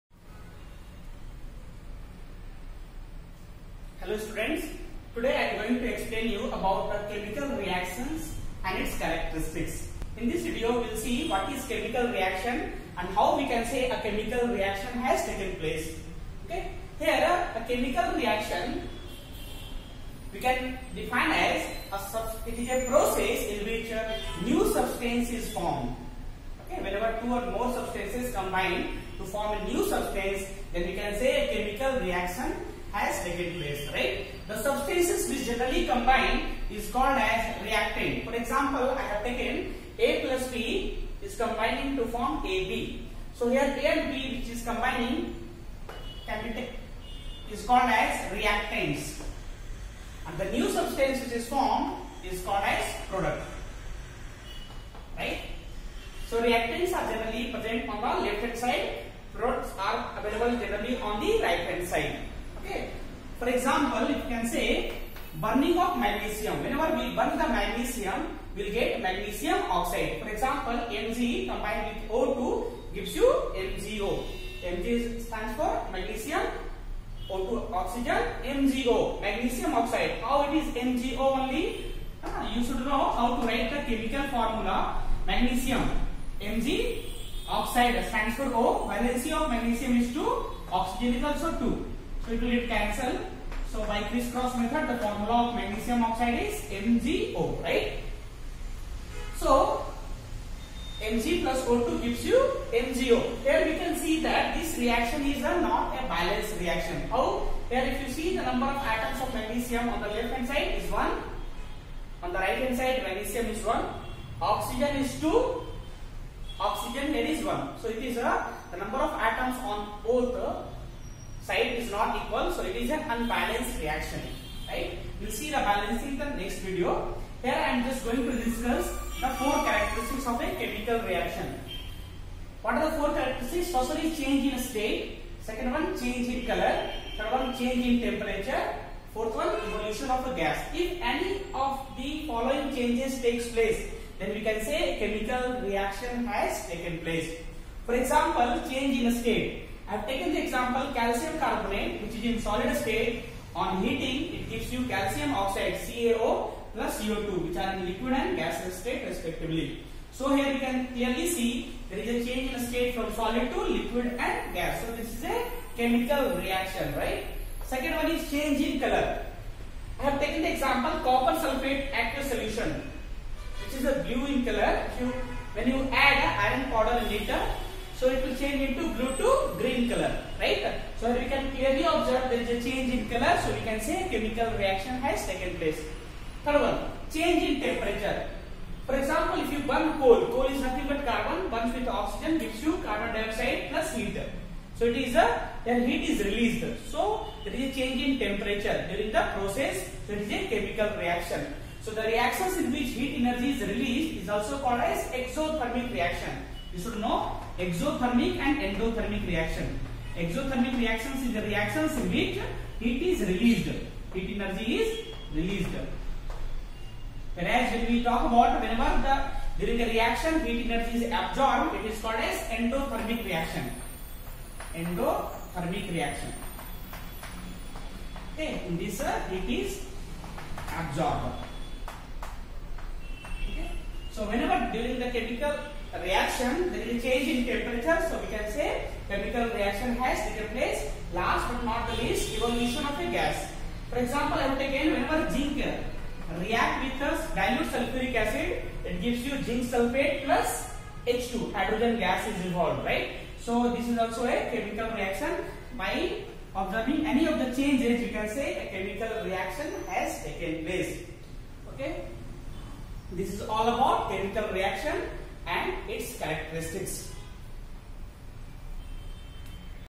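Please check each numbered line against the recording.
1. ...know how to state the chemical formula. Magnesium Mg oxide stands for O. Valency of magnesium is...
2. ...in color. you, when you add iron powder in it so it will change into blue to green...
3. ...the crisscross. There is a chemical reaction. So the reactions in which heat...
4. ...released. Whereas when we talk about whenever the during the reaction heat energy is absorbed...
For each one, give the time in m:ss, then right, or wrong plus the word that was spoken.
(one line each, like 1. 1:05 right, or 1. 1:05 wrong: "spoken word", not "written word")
1. 1:22 wrong: "write", not "state"
2. 2:54 right
3. 3:19 wrong: "process", not "crisscross"
4. 3:35 right.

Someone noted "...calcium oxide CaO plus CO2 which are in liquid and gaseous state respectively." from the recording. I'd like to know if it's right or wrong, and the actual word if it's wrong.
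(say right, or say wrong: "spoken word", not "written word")
right.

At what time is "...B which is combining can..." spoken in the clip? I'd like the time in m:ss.
0:44.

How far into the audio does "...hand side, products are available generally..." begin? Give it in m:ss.
0:58.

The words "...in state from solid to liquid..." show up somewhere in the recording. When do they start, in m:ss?
2:42.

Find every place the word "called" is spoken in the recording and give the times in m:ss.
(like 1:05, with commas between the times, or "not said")
0:36, 0:47, 0:52, 3:24, 3:42.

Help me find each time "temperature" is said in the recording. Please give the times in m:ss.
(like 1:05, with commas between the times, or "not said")
2:18, 3:07, 3:18, 3:57.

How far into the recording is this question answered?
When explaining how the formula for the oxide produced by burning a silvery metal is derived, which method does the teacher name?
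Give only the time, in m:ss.
1:34.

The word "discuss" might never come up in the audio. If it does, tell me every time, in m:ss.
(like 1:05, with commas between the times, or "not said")
2:08.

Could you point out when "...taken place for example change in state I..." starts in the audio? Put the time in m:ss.
2:26.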